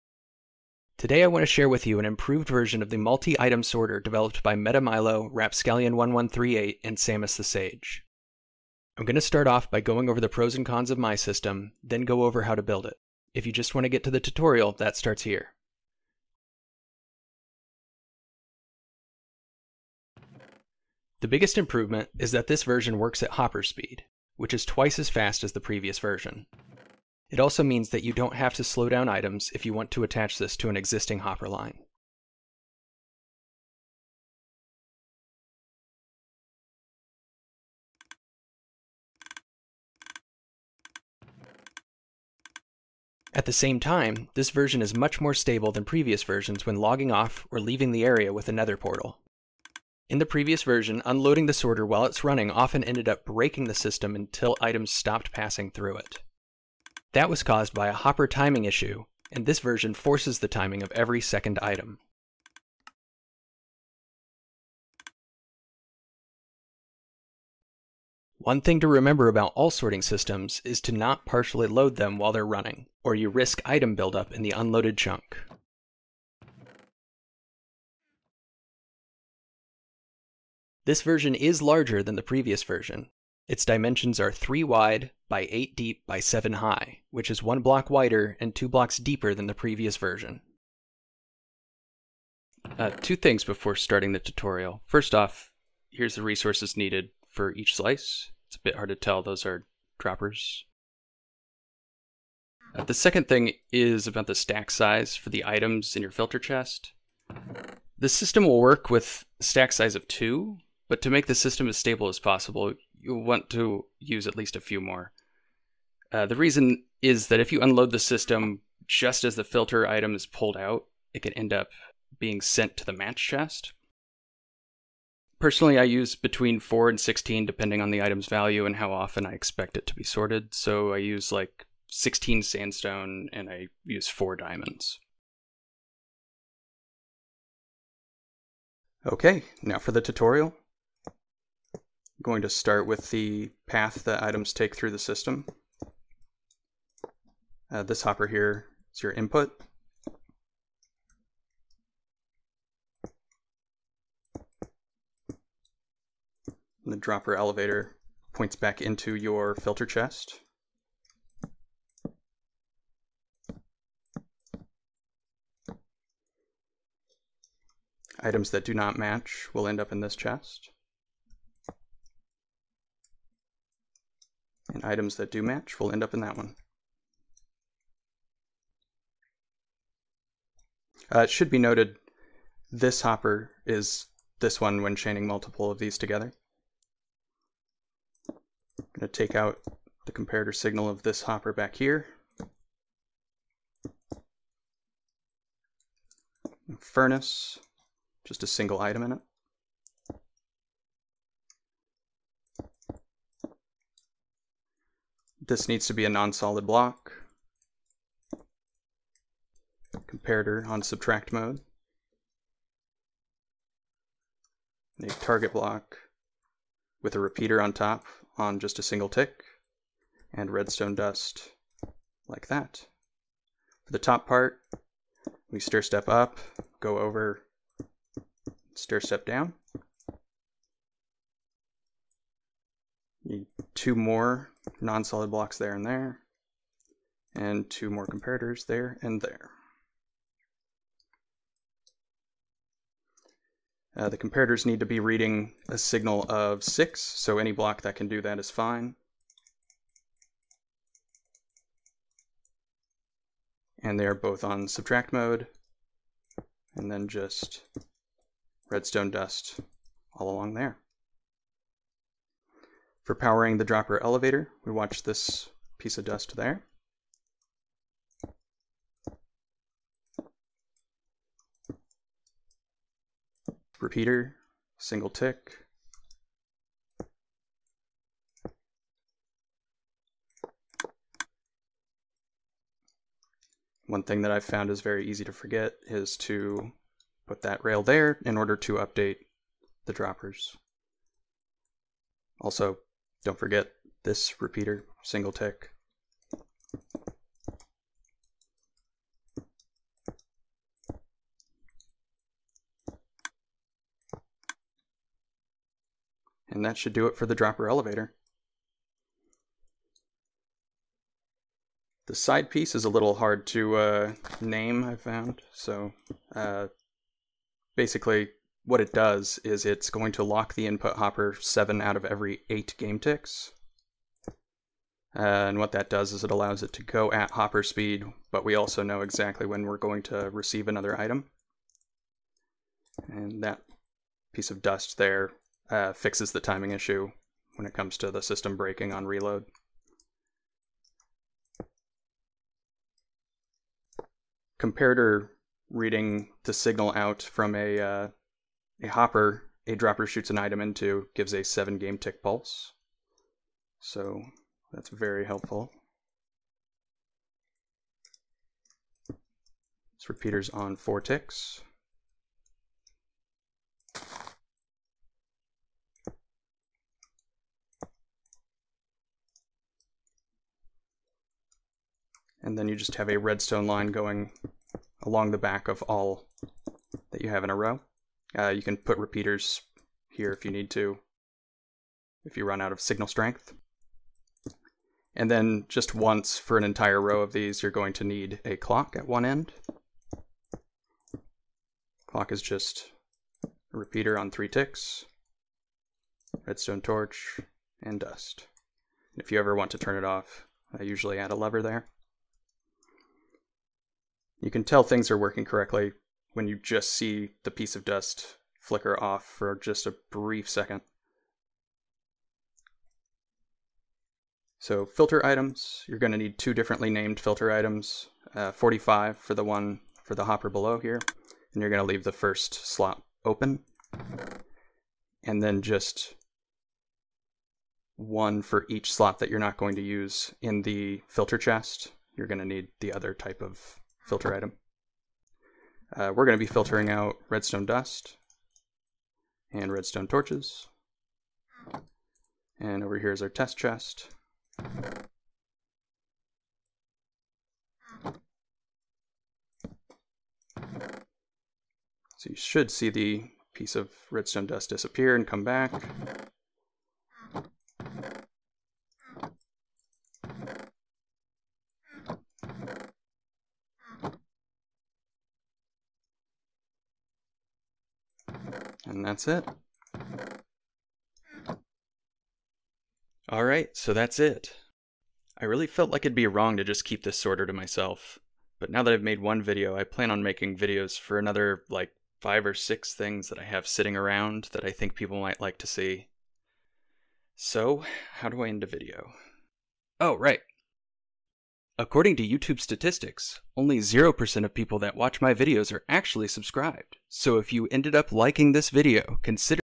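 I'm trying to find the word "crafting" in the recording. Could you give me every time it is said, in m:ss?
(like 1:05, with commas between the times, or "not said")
not said.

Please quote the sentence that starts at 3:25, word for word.
This needs to be a non-solid block comparator on subtract mode.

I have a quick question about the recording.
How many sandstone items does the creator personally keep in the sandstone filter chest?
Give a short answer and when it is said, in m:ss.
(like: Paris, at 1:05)
16, at 2:11.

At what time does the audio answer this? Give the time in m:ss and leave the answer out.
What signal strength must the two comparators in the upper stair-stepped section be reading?
4:05.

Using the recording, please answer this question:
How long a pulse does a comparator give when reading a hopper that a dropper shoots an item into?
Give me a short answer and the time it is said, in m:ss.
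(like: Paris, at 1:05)
7 game ticks, at 5:51.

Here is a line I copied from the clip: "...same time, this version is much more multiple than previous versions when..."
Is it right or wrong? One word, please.
wrong.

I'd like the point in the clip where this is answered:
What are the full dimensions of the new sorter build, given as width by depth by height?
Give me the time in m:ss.
1:24.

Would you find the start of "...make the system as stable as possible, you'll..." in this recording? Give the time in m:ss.
1:51.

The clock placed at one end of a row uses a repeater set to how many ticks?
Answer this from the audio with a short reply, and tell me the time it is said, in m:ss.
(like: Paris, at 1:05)
3, at 6:34.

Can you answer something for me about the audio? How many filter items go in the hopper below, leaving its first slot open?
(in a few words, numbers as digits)
45.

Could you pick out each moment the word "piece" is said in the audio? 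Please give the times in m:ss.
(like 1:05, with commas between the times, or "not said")
4:25, 5:12, 5:34, 6:47, 7:33.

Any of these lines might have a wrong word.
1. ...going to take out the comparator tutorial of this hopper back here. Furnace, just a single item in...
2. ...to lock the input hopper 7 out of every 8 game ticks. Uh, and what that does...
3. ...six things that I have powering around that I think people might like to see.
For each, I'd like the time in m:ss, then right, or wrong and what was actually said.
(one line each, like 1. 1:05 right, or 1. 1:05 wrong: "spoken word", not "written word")
1. 3:08 wrong: "signal", not "tutorial"
2. 5:20 right
3. 8:02 wrong: "sitting", not "powering".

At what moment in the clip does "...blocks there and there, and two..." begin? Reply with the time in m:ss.
3:55.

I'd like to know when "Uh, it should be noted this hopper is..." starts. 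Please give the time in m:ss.
3:01.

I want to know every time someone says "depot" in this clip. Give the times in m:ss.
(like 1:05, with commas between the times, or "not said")
not said.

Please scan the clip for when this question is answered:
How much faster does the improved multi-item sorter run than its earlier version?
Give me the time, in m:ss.
0:24.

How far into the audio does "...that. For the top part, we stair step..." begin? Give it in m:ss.
3:42.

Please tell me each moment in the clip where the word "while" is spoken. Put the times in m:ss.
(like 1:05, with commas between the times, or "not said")
0:51, 1:12.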